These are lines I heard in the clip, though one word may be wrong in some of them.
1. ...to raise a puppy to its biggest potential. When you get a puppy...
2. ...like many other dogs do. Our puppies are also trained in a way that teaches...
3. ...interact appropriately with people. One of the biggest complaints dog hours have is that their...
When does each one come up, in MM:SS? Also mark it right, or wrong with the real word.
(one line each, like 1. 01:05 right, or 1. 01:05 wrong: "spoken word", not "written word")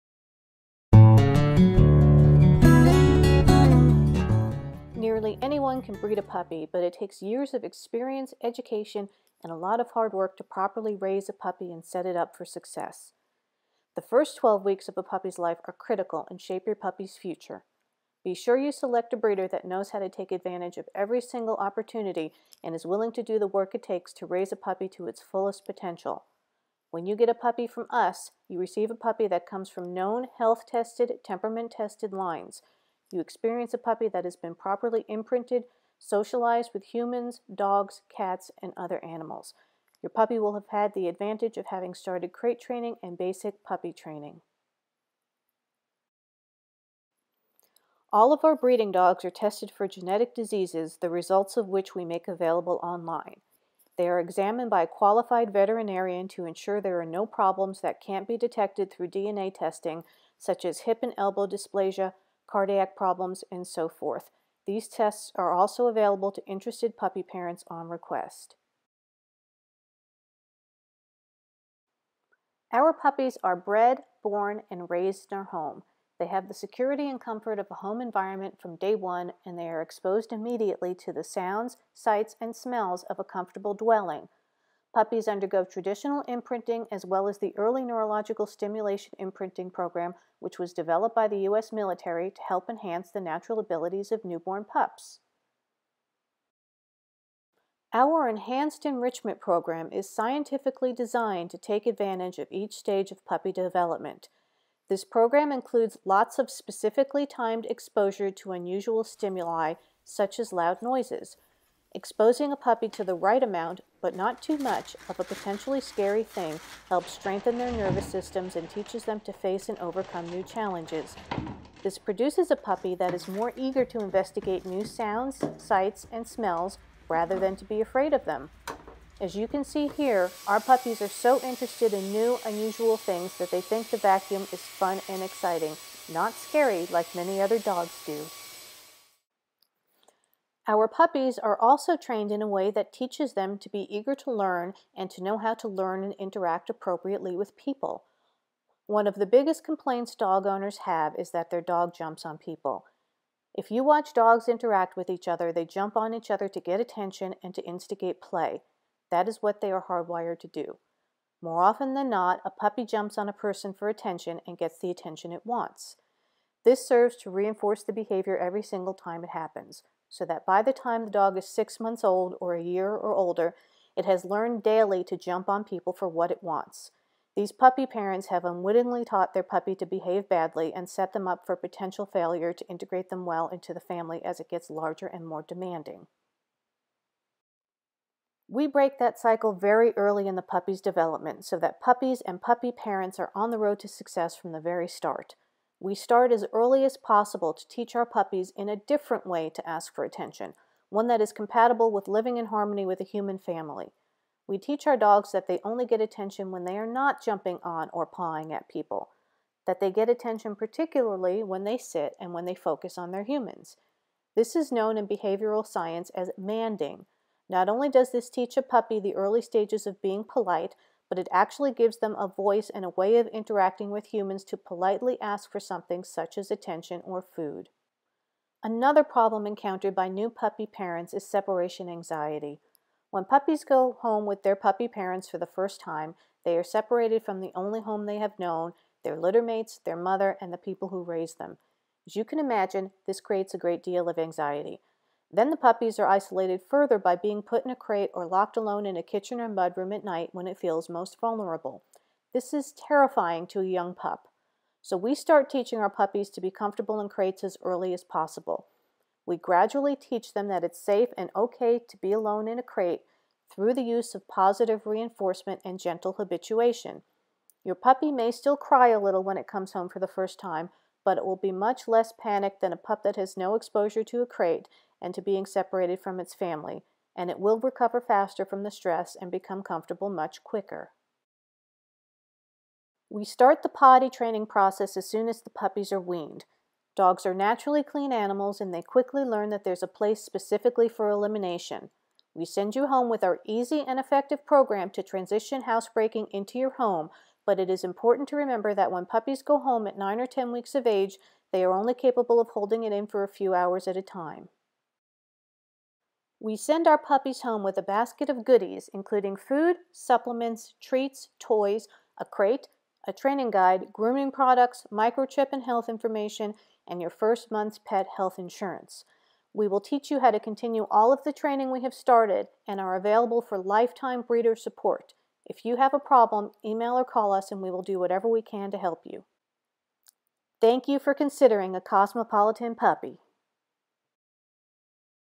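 1. 00:24 wrong: "fullest", not "biggest"
2. 02:16 right
3. 02:26 wrong: "owners", not "hours".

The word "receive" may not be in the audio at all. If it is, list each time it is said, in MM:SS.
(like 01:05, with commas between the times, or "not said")
00:28.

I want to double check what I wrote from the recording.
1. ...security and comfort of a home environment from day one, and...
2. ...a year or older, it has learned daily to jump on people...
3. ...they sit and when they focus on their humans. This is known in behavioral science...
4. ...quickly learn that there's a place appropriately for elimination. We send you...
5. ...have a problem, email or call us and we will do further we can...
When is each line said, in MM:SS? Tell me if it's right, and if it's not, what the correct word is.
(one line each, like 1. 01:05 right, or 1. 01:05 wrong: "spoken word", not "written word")
1. 01:16 right
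2. 02:52 right
3. 03:31 right
4. 04:48 wrong: "specifically", not "appropriately"
5. 05:25 wrong: "whatever", not "further".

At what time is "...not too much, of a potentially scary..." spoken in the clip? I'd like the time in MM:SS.
01:54.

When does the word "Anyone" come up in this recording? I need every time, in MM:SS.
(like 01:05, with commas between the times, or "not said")
00:05.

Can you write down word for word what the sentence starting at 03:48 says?
Another problem encountered by new puppy parents is separation anxiety.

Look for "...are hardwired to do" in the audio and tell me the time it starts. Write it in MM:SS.
02:39.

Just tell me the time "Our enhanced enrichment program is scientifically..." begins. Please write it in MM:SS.
01:37.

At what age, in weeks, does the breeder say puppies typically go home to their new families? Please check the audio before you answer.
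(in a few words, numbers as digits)
9 or 10 weeks.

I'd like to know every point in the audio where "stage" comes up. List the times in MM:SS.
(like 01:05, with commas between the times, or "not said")
01:42, 03:39.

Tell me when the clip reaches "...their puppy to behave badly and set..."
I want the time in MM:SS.
02:59.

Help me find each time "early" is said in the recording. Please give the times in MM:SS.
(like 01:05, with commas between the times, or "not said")
01:27, 03:09, 03:16, 03:39, 04:17.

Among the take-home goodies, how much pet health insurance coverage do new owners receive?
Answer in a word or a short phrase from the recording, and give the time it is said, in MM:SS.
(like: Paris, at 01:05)
first month's, at 05:17.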